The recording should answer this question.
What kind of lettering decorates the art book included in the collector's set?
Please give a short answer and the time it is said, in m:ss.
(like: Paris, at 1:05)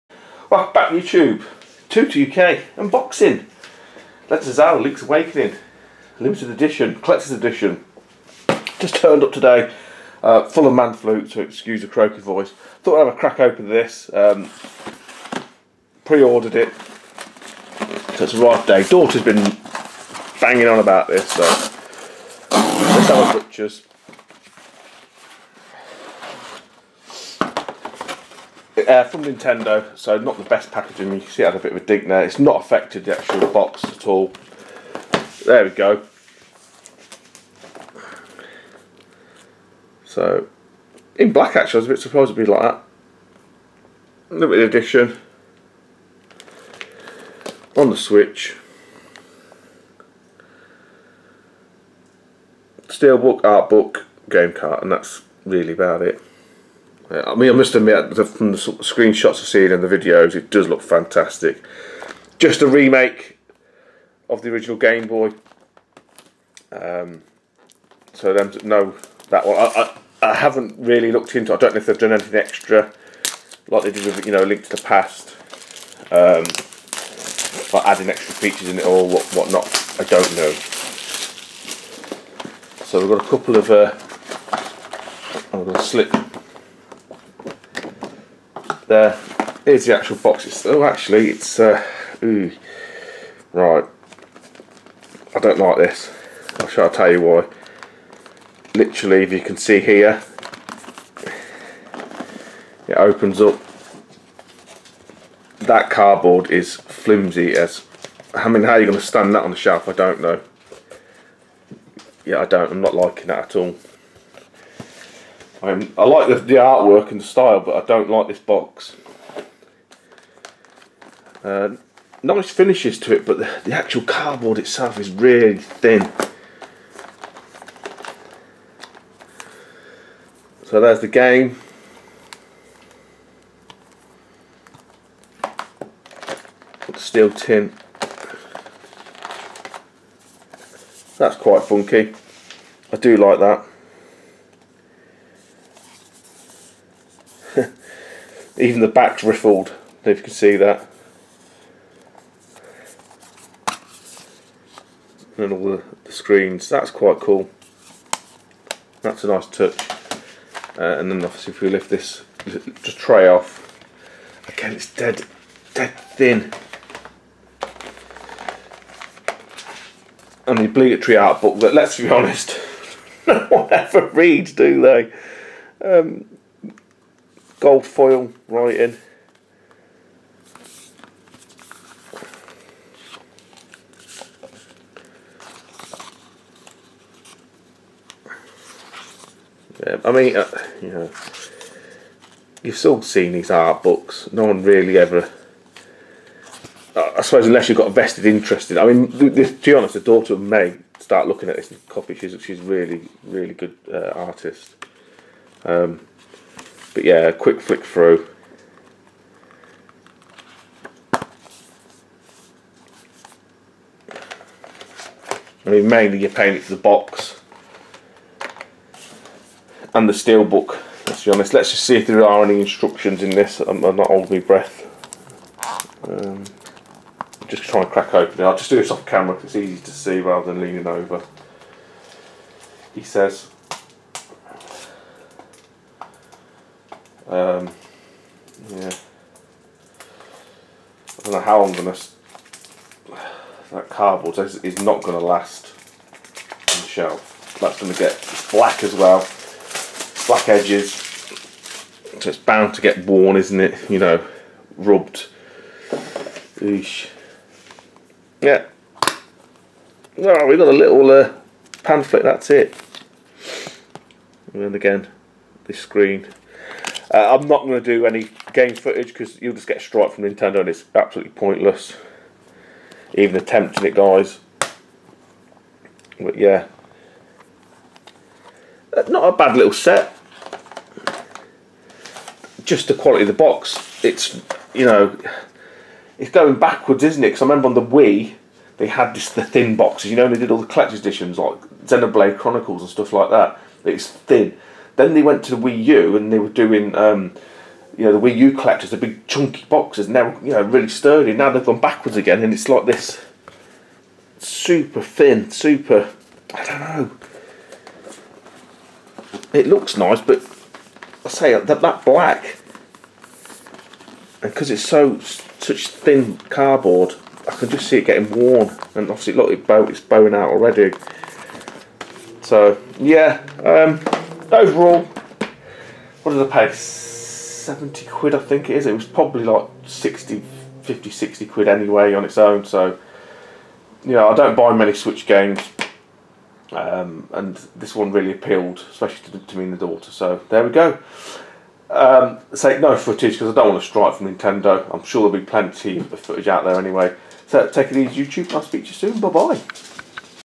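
gold foil, at 2:57.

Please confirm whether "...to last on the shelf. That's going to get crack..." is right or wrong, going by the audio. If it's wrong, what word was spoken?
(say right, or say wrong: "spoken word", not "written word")
wrong: "black", not "crack".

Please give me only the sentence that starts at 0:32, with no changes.
It's not affected the actual box at all.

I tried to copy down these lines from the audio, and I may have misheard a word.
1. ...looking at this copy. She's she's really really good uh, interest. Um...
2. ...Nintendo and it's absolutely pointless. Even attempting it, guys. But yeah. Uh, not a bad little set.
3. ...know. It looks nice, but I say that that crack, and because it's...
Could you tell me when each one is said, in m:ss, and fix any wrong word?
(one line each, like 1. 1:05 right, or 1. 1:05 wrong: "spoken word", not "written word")
1. 3:21 wrong: "artist", not "interest"
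2. 4:30 right
3. 5:06 wrong: "black", not "crack".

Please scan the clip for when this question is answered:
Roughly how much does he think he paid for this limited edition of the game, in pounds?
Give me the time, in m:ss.
5:26.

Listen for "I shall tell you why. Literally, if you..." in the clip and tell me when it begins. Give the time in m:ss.
1:36.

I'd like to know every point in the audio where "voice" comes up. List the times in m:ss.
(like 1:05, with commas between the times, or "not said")
0:12.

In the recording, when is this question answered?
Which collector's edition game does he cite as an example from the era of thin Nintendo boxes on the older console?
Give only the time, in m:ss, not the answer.
4:51.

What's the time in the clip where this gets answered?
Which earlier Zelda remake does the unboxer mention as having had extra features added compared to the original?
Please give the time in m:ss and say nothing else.
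1:14.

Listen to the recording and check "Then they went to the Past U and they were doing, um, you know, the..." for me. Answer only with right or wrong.
wrong.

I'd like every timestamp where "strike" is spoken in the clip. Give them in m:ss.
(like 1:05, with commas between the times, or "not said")
4:29, 5:43.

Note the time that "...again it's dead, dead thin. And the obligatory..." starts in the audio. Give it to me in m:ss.
2:44.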